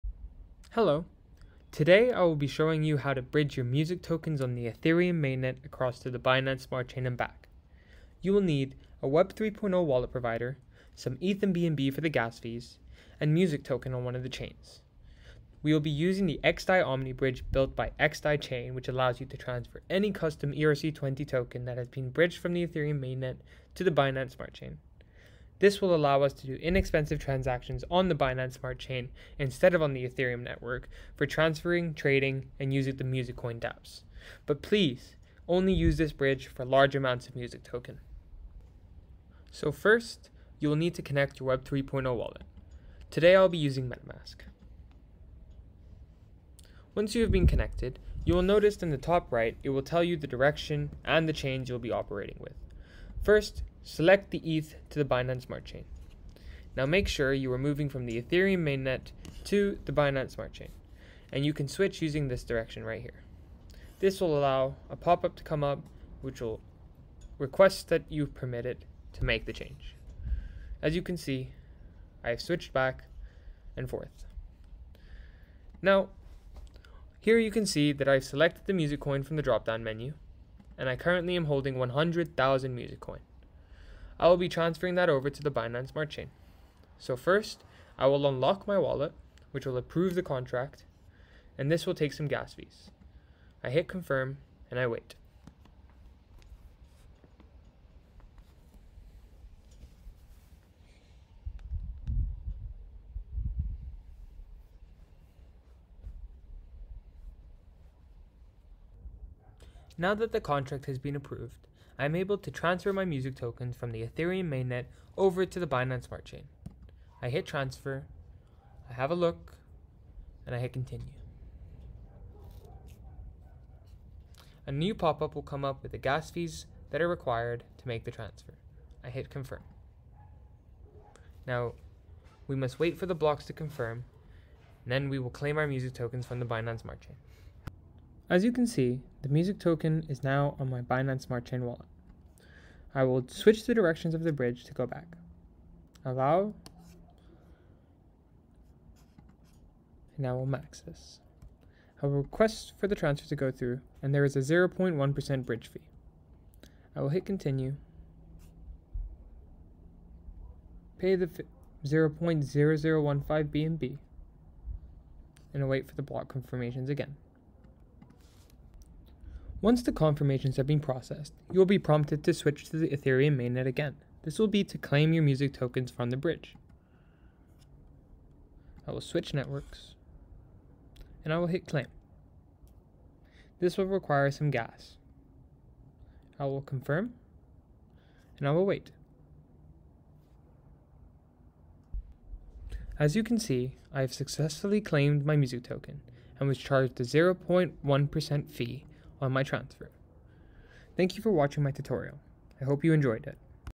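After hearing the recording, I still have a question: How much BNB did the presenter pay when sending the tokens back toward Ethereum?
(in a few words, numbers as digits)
0.0015 BNB.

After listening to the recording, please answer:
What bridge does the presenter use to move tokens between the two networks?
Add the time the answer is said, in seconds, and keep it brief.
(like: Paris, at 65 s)
XDAI Omni bridge, at 16 s.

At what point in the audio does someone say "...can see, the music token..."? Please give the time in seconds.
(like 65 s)
138 s.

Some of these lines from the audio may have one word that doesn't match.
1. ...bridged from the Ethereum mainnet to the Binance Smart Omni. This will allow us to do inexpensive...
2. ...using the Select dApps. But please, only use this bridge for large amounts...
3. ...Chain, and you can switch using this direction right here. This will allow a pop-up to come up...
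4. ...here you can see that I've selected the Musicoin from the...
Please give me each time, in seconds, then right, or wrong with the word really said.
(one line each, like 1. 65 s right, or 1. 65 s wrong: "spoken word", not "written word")
1. 22 s wrong: "Chain", not "Omni"
2. 32 s wrong: "Musicoin", not "Select"
3. 60 s right
4. 77 s right.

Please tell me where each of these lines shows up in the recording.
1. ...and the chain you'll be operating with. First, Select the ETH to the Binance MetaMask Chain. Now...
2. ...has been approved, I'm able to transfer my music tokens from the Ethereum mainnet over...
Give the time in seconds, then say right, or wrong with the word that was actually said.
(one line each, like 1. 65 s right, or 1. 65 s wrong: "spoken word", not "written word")
1. 51 s wrong: "Smart", not "MetaMask"
2. 110 s right.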